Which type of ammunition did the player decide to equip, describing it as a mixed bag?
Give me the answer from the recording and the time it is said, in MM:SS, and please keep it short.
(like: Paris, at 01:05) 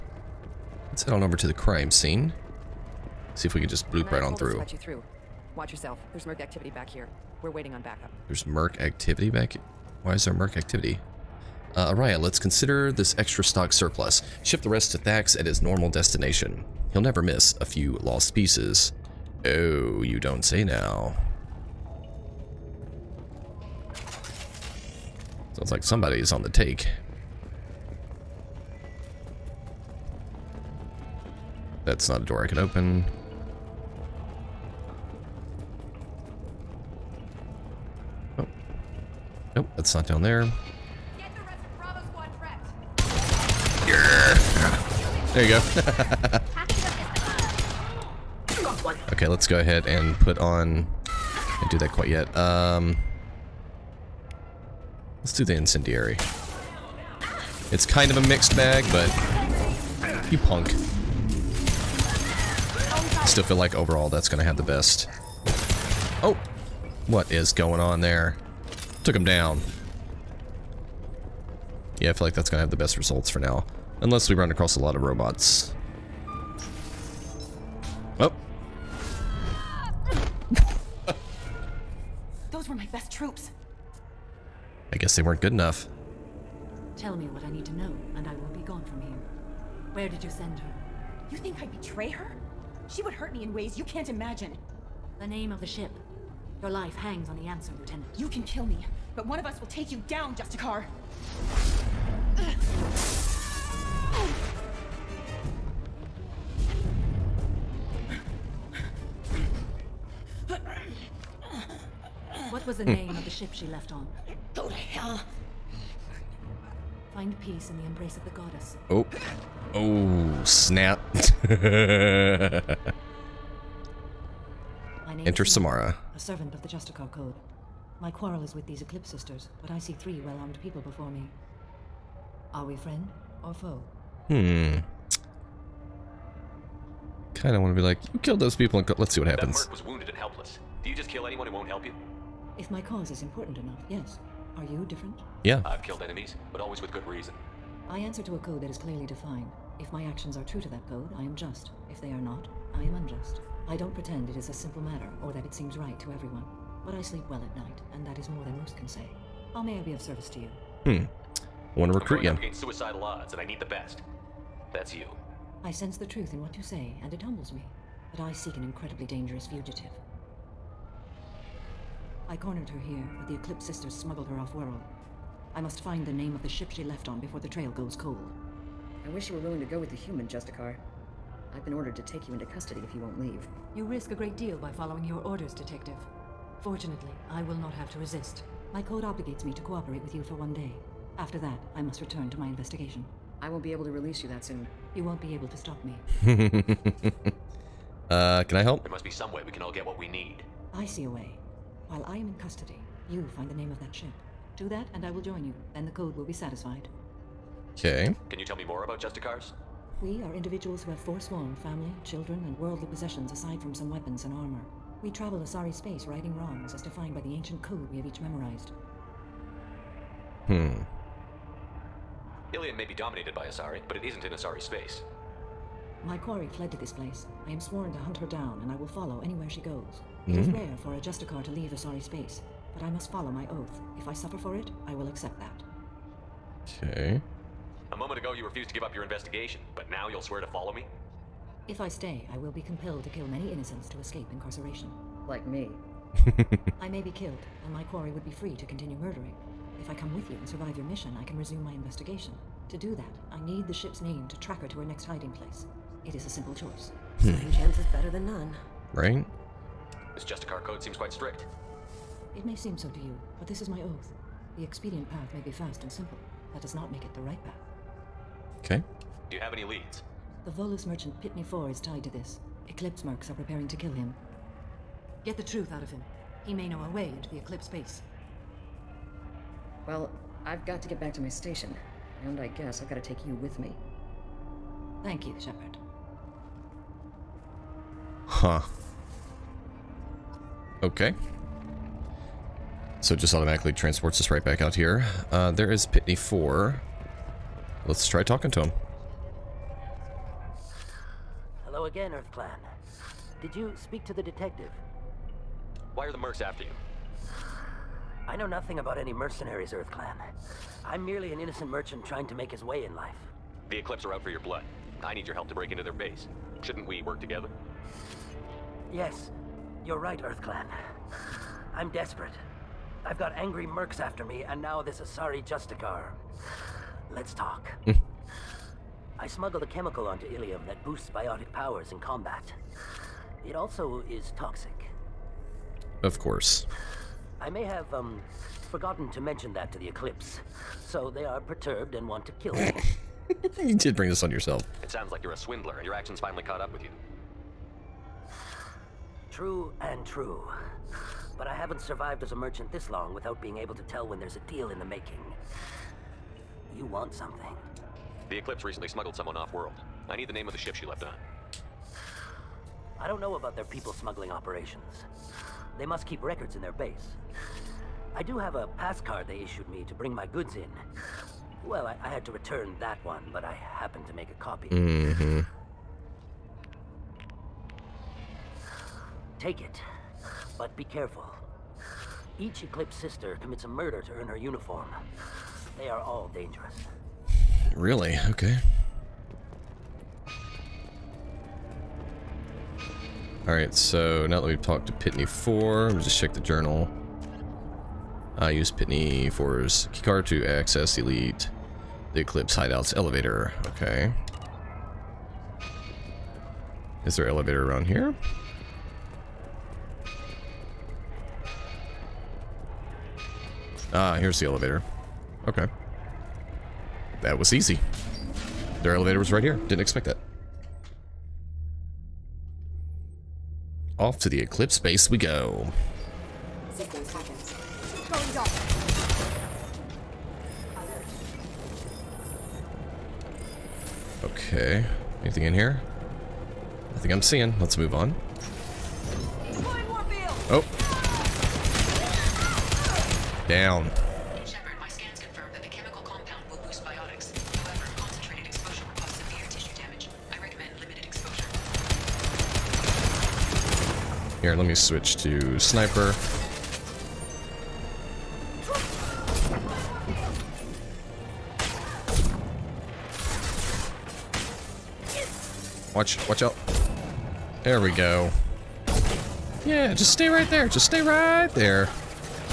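Incendiary, at 00:55.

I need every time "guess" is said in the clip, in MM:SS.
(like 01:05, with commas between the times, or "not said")
01:24, 04:42.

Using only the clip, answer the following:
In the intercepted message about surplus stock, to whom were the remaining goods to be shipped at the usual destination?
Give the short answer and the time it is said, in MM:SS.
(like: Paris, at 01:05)
Thax, at 00:14.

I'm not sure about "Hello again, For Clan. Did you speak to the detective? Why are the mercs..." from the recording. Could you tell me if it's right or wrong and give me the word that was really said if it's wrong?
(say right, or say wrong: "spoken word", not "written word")
wrong: "Earth", not "For".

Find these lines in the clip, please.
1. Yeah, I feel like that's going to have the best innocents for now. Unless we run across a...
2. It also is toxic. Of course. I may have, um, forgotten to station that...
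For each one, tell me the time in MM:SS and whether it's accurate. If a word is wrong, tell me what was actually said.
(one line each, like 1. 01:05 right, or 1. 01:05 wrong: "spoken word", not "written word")
1. 01:12 wrong: "results", not "innocents"
2. 05:33 wrong: "mention", not "station".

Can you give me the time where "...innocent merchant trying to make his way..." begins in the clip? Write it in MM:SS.
05:11.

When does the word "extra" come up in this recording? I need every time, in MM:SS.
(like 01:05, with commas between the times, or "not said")
00:13.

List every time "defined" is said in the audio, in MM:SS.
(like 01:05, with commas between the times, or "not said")
02:29, 03:36.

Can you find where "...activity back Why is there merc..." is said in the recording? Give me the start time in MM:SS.
00:08.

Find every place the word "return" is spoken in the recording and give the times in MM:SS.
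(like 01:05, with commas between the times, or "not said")
03:12, 06:12.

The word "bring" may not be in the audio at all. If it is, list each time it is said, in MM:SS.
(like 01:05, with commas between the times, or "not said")
05:43, 06:09.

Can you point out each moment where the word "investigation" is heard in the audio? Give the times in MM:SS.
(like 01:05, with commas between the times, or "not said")
03:12, 03:59, 04:11.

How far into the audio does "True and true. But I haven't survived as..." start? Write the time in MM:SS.
05:49.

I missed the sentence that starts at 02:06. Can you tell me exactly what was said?
A servant of the Justicar Code.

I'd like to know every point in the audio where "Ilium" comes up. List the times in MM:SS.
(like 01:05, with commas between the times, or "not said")
03:42, 05:30.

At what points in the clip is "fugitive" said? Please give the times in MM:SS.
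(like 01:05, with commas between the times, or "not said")
02:49.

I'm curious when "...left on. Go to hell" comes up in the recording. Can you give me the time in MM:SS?
01:53.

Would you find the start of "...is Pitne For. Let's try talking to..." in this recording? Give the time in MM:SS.
04:55.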